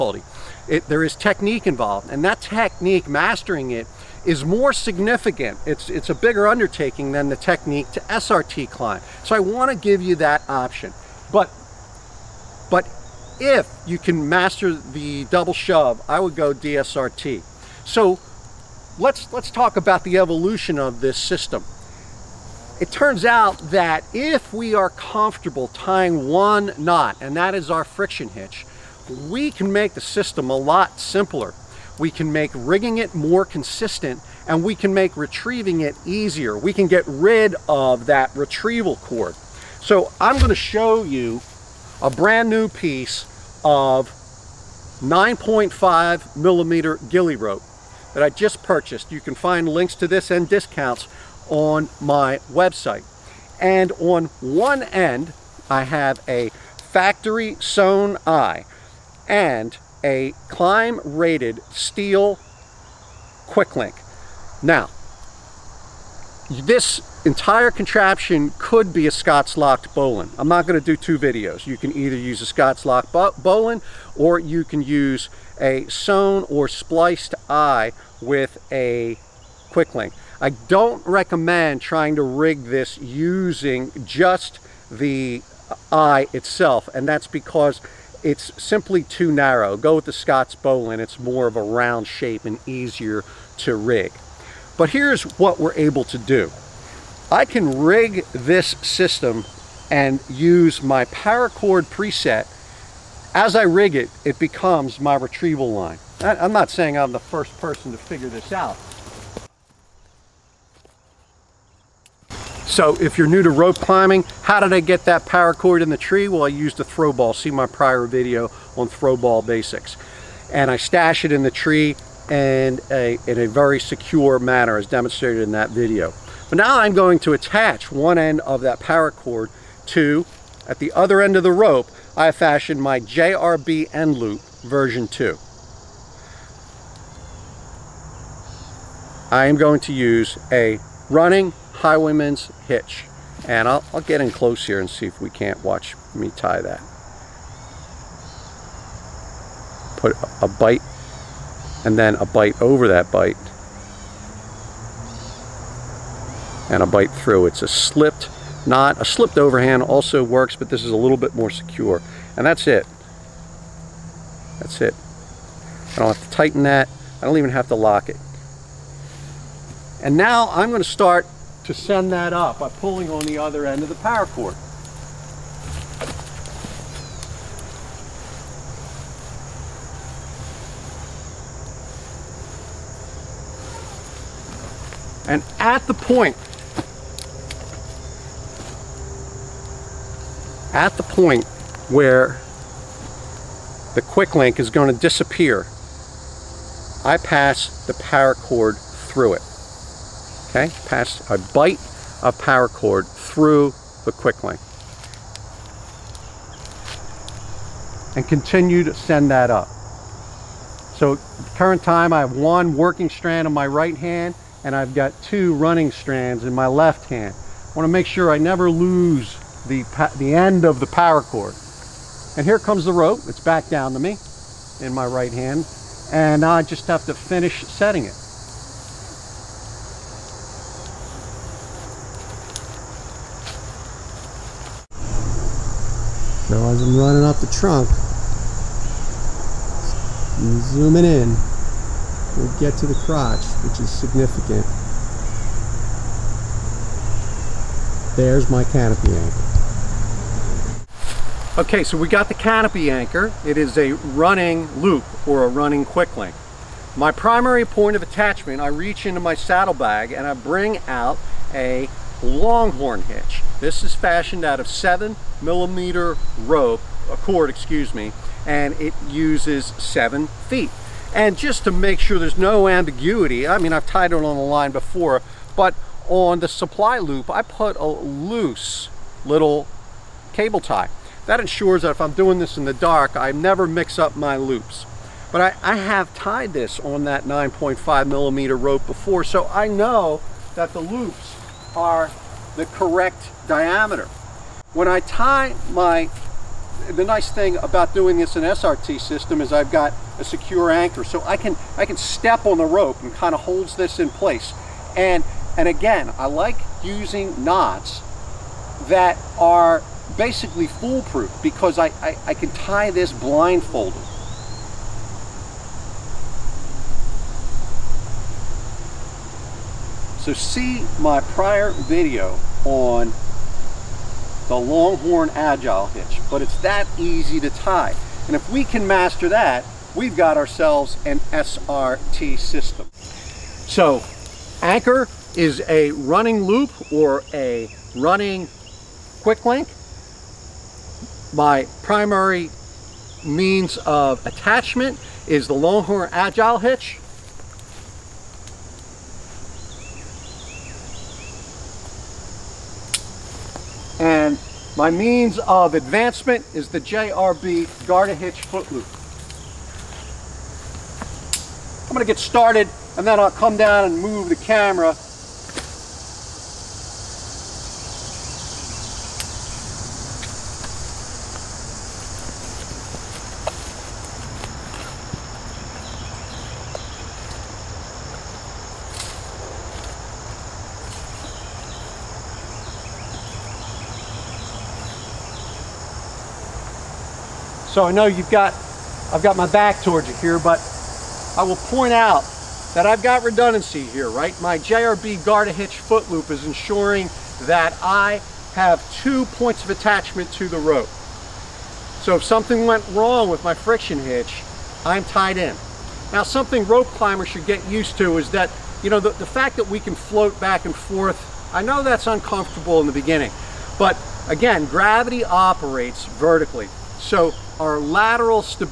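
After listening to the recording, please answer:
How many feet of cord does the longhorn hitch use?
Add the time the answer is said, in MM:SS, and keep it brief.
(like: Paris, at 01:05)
7 feet, at 04:29.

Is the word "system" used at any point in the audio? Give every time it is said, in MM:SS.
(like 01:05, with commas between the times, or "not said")
00:21, 00:29, 01:38, 04:58, 05:32.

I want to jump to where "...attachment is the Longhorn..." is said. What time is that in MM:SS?
05:44.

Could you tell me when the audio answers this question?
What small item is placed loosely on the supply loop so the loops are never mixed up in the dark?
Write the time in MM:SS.
04:40.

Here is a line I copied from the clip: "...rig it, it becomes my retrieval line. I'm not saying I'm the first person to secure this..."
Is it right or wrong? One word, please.
wrong.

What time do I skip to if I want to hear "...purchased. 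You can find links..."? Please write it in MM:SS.
00:48.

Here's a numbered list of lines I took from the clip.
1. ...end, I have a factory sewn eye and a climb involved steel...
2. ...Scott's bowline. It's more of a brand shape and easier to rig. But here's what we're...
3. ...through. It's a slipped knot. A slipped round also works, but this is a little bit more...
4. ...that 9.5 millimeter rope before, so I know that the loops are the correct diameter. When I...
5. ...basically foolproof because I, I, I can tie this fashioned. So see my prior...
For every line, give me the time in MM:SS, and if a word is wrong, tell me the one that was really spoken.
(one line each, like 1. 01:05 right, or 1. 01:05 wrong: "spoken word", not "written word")
1. 00:54 wrong: "rated", not "involved"
2. 01:30 wrong: "round", not "brand"
3. 02:37 wrong: "overhand", not "round"
4. 04:47 right
5. 05:10 wrong: "blindfolded", not "fashioned".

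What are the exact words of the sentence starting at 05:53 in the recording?
And my means of advancement is the JRB Garda Hitch Foot Loop.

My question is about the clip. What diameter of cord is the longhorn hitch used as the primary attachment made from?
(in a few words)
7 millimeter.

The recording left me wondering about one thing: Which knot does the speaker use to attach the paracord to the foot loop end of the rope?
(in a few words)
running highwayman's hitch.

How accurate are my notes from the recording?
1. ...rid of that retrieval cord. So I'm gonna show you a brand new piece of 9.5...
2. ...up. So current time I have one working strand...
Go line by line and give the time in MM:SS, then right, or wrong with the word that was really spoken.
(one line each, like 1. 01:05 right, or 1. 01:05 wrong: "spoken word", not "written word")
1. 00:37 right
2. 03:29 right.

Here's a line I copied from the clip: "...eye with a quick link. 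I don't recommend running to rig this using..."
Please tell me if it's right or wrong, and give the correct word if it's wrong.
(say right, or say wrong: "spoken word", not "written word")
wrong: "trying", not "running".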